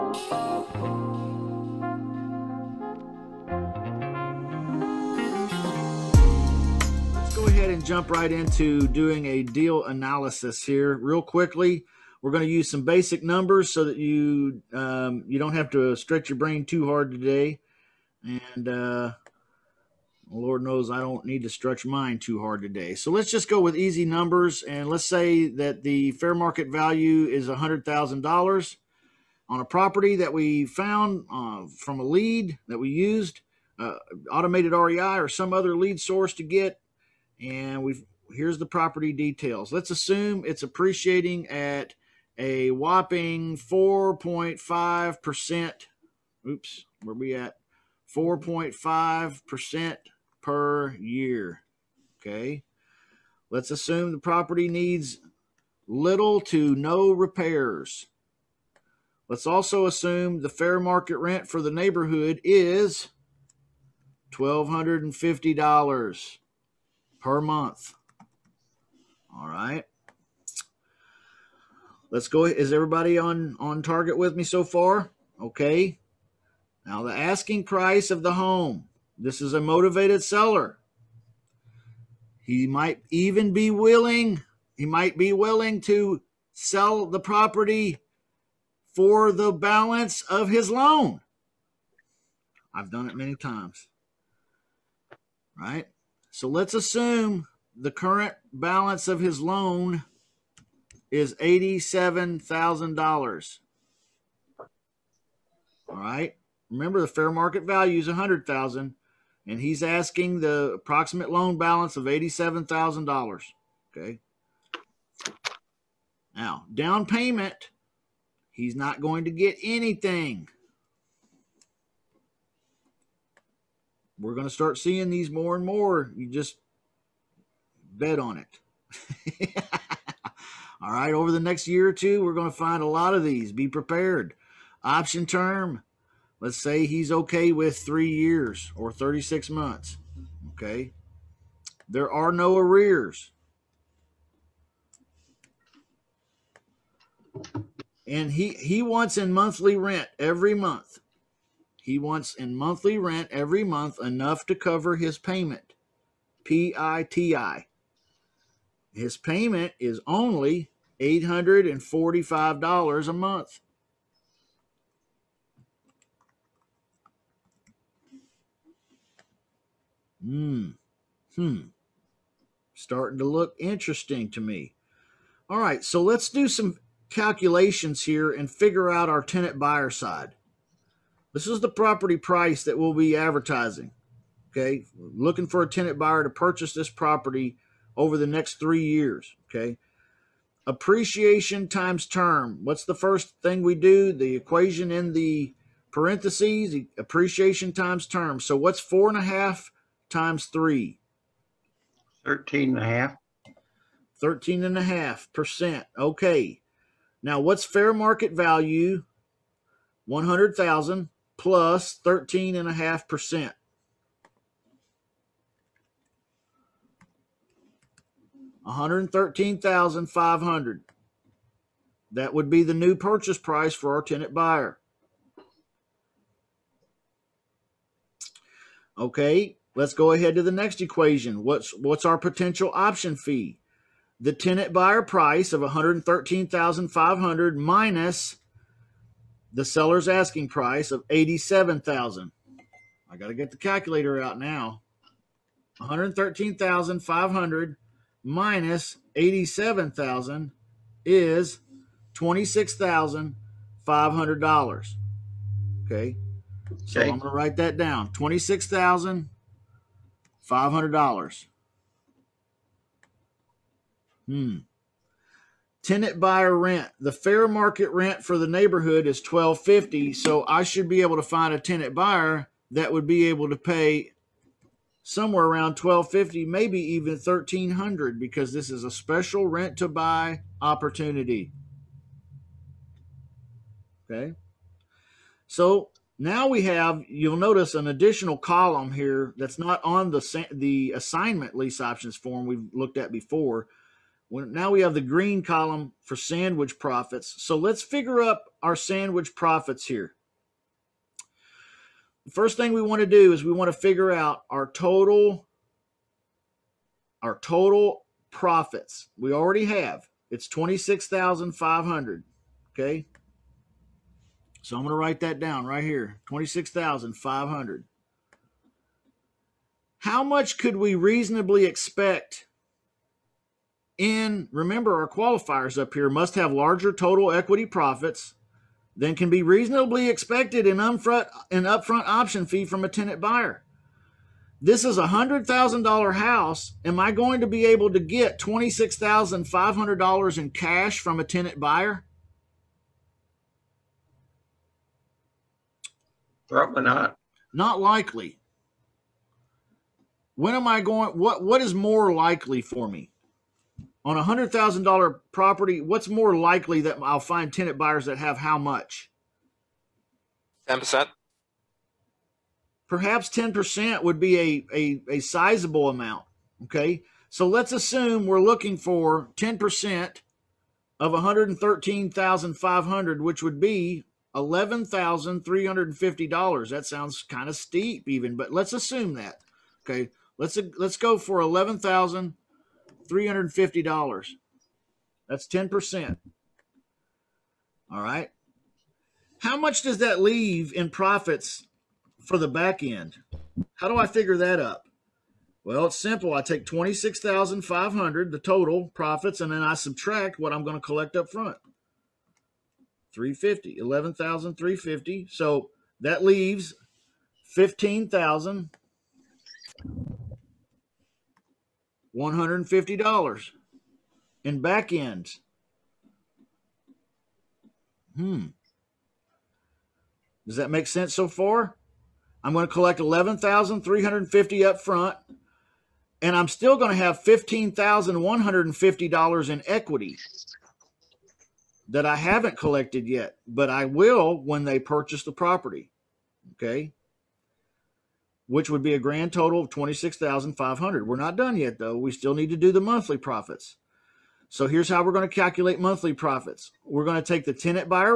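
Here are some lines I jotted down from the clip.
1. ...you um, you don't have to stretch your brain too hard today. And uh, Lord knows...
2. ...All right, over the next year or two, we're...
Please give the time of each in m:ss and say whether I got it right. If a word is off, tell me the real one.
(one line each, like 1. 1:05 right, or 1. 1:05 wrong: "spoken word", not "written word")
1. 0:13 right
2. 2:10 right.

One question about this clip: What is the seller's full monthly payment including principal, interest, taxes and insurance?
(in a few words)
$845.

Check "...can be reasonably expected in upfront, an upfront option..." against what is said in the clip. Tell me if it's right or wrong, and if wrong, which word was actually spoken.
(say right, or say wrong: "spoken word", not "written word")
right.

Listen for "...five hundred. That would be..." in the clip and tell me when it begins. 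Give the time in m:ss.
3:40.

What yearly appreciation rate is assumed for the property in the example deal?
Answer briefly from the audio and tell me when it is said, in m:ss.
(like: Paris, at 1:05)
4.5%, at 0:48.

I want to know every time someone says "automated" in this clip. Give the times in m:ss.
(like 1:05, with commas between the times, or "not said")
0:34.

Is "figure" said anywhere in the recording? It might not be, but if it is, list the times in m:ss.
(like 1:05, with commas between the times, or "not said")
2:58, 4:57, 5:03, 6:34.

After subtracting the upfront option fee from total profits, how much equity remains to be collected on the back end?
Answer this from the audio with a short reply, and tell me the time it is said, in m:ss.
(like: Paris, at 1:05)
$15,150, at 6:47.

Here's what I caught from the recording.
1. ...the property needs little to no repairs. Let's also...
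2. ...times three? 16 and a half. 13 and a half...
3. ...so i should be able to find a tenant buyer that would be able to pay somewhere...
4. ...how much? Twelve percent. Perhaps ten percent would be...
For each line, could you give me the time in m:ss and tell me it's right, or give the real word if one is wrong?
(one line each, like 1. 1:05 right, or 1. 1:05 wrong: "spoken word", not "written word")
1. 0:54 right
2. 3:20 wrong: "13", not "16"
3. 4:30 right
4. 5:58 wrong: "Ten", not "Twelve".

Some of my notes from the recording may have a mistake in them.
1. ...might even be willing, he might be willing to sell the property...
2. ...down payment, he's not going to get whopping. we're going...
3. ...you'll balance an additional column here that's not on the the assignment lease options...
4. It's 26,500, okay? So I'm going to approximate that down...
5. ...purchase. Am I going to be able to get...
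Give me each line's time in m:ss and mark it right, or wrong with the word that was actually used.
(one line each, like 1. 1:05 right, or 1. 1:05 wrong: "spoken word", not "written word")
1. 1:22 right
2. 1:56 wrong: "anything", not "whopping"
3. 4:47 wrong: "notice", not "balance"
4. 5:10 wrong: "write", not "approximate"
5. 5:36 wrong: "house", not "purchase".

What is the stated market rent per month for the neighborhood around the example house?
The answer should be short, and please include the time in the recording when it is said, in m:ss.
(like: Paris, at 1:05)
$1,250, at 1:04.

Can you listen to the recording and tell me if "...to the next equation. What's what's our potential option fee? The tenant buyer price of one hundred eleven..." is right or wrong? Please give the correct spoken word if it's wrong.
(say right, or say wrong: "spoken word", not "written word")
wrong: "thirteen", not "eleven".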